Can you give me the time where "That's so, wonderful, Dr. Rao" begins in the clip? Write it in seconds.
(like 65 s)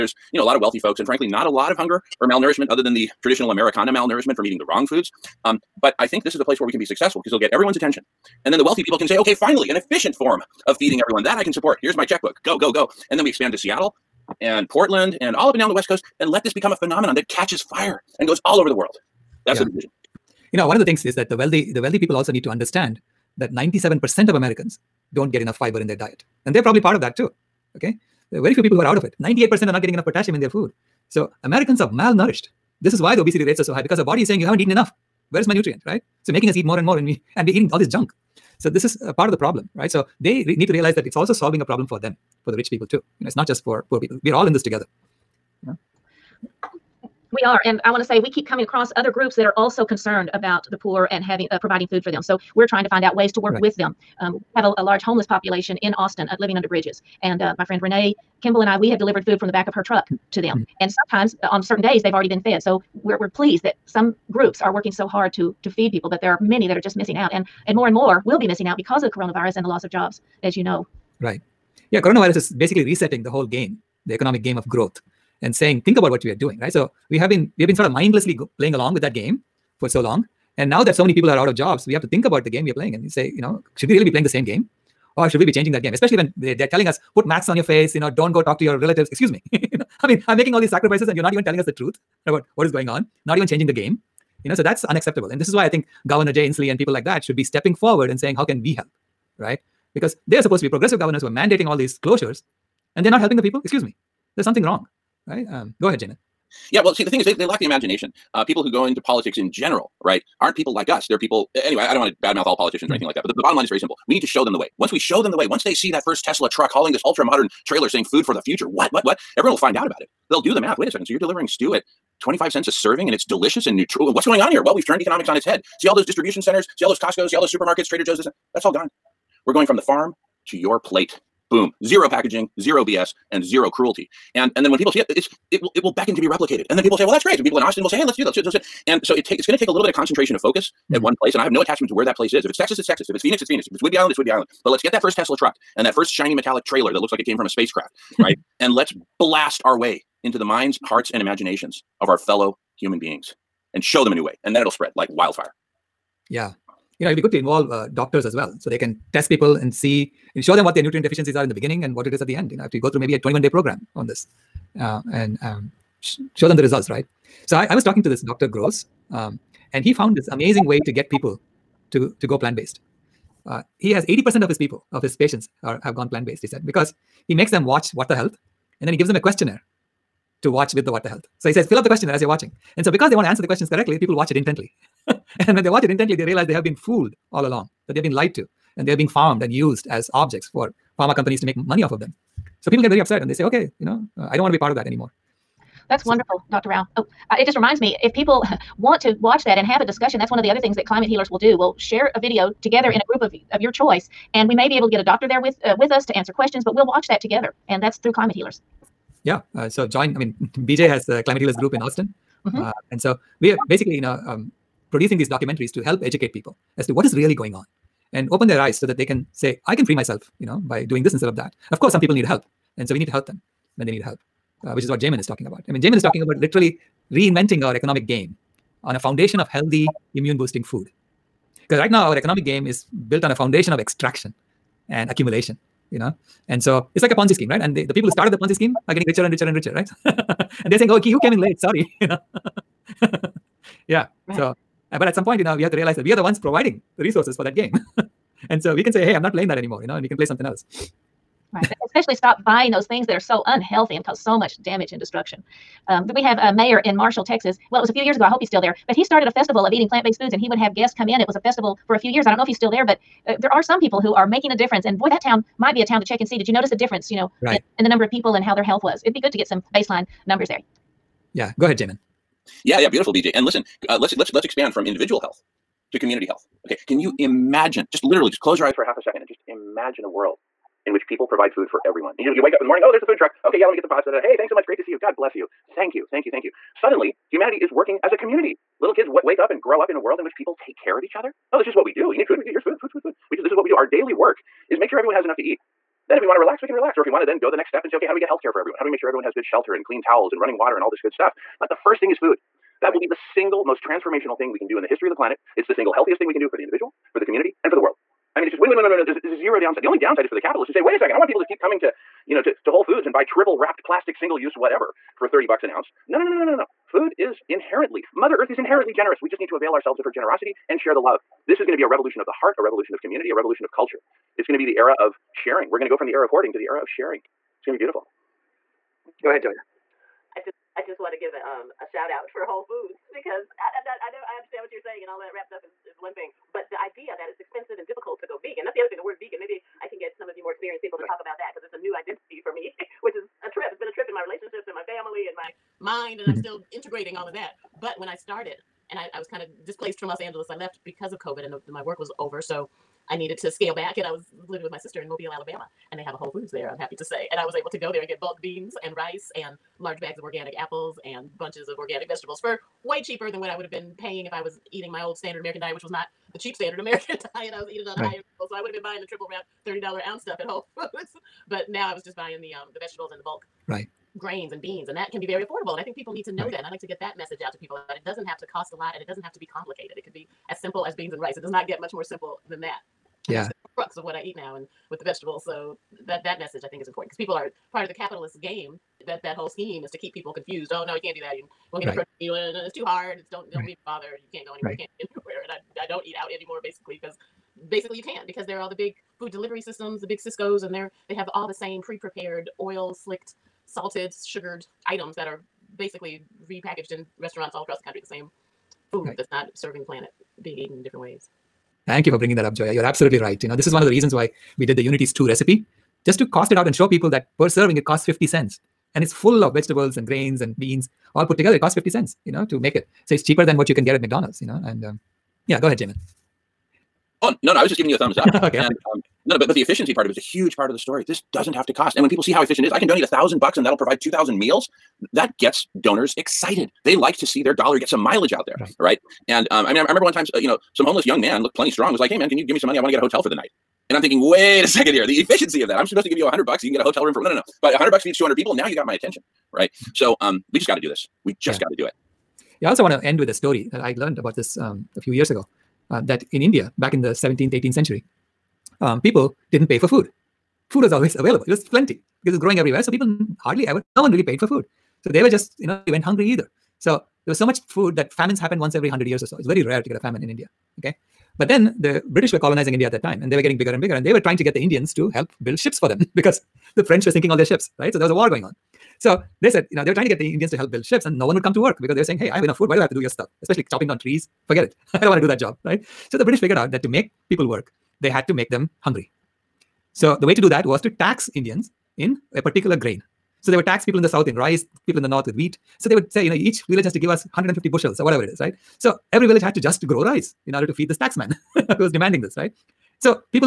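195 s.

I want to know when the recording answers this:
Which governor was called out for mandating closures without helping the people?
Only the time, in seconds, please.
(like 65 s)
96 s.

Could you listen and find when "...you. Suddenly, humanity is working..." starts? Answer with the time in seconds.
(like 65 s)
286 s.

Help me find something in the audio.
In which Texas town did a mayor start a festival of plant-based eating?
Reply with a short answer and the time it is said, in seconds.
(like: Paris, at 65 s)
Marshall, at 256 s.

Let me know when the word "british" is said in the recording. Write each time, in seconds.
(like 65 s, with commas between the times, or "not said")
472 s, 486 s.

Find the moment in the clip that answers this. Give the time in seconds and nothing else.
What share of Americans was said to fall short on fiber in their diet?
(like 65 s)
23 s.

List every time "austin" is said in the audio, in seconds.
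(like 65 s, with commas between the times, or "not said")
55 s, 137 s, 211 s.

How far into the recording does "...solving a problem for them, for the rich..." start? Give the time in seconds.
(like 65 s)
41 s.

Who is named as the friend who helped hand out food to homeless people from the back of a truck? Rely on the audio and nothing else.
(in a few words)
Renee Kimball.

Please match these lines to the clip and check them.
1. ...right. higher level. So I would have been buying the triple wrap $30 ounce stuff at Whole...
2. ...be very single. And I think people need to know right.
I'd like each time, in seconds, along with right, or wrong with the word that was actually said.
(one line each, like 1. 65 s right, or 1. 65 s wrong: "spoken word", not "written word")
1. 368 s right
2. 375 s wrong: "affordable", not "single".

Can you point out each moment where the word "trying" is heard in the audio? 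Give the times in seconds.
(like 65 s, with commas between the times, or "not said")
52 s, 474 s, 479 s.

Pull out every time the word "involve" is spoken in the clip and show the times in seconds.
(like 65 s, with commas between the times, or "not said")
157 s.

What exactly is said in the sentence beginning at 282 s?
And you, you wake up in the morning, oh, there's the food truck.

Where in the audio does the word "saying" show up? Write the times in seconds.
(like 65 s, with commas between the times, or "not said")
34 s, 75 s, 98 s, 117 s, 240 s, 334 s, 482 s.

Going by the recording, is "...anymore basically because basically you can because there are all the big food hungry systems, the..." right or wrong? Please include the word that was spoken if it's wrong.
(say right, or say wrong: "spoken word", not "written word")
wrong: "delivery", not "hungry".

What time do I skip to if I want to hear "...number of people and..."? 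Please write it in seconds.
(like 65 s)
267 s.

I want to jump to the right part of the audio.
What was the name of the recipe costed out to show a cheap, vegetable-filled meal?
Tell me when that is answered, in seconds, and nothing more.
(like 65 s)
414 s.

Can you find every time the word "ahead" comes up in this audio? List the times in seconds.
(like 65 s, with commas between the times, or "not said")
105 s, 271 s, 329 s, 425 s.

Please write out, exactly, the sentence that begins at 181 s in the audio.
So he says, fill up the questionnaire as you're watching.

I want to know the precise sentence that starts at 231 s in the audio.
Because right now, our economic game is built on a foundation of extraction and accumulation, you know.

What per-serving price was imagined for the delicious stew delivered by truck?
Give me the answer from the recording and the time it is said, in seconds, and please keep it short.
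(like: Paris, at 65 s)
25 cents, at 122 s.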